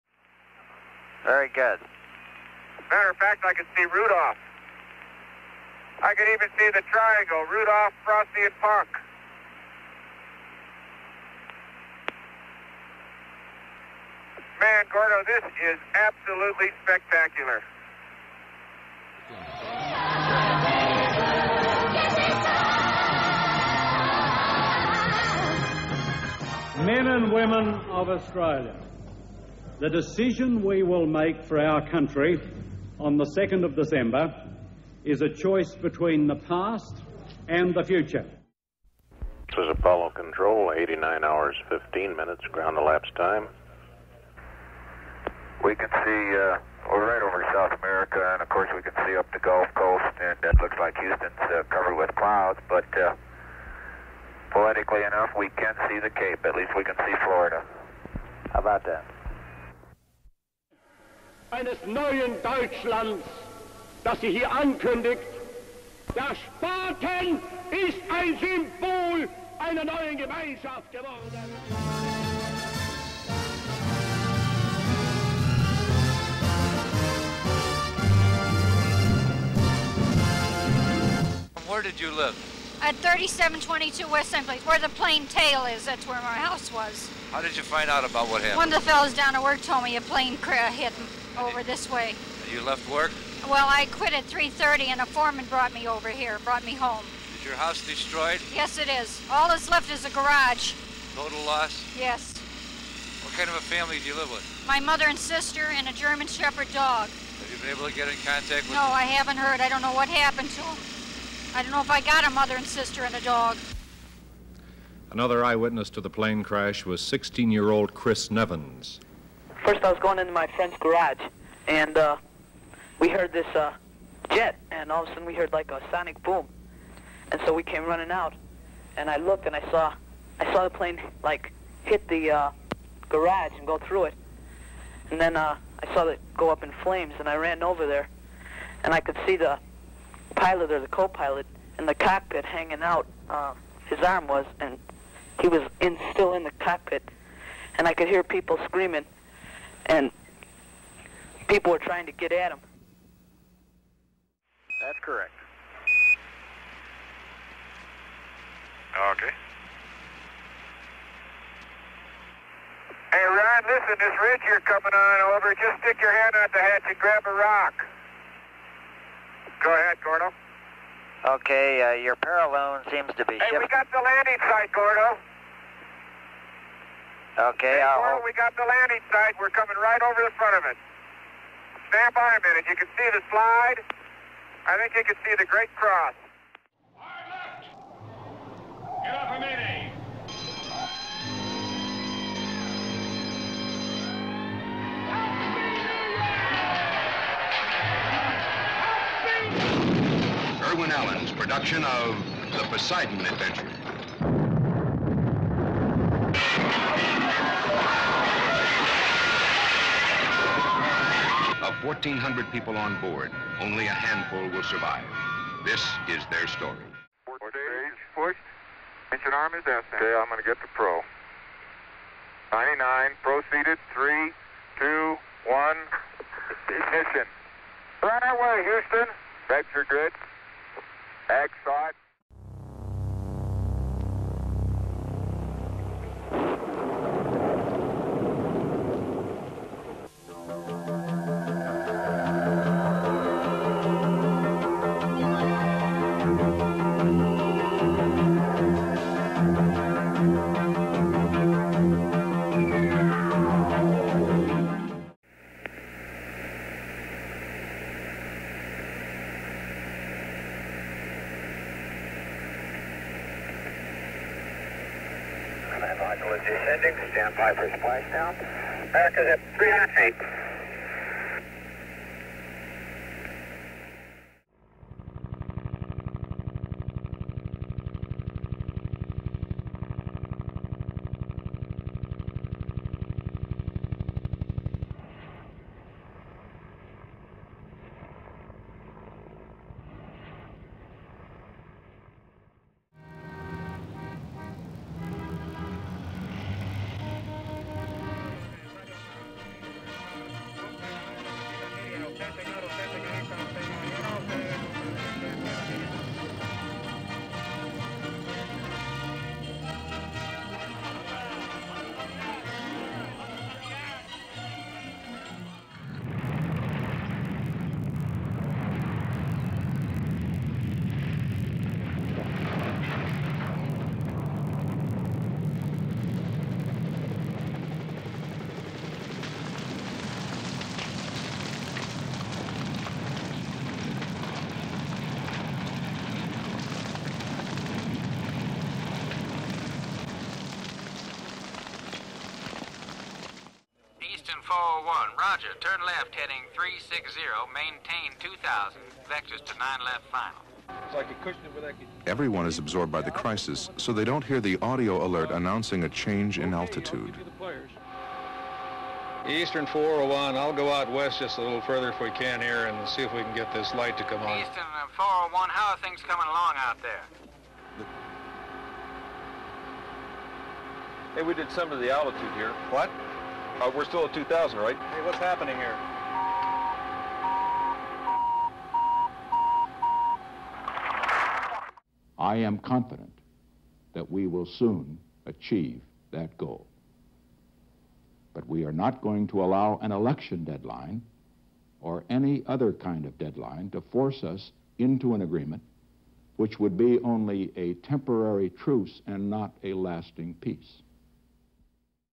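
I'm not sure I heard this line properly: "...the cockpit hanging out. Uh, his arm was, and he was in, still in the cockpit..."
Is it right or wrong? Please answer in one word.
right.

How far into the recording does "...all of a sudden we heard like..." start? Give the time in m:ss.
2:04.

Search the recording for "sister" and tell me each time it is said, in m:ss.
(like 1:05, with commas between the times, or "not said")
1:45, 1:52.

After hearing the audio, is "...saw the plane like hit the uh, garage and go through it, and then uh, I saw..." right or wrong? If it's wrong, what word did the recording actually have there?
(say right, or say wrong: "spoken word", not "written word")
right.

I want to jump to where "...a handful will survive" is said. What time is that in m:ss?
3:33.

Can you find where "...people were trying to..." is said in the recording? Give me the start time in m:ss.
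2:31.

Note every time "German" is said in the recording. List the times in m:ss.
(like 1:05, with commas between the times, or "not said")
1:45.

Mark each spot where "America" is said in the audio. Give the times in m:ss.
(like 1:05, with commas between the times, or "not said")
0:47, 4:28.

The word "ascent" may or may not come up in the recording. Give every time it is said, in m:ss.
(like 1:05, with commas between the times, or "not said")
3:39.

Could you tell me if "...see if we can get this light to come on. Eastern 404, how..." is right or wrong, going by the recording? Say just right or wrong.
wrong.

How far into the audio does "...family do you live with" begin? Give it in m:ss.
1:43.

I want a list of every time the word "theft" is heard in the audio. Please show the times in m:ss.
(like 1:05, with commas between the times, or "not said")
not said.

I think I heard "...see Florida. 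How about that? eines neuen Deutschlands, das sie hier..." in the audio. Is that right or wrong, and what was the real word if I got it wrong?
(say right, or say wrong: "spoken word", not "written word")
right.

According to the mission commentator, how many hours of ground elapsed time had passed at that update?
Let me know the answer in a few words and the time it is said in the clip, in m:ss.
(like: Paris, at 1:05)
89, at 0:40.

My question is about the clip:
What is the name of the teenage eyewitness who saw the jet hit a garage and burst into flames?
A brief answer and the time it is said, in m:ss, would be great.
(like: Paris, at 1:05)
Chris Nevins, at 1:57.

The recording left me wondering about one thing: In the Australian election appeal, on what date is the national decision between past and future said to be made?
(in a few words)
2 December.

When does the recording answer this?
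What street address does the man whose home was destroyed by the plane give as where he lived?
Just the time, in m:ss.
1:23.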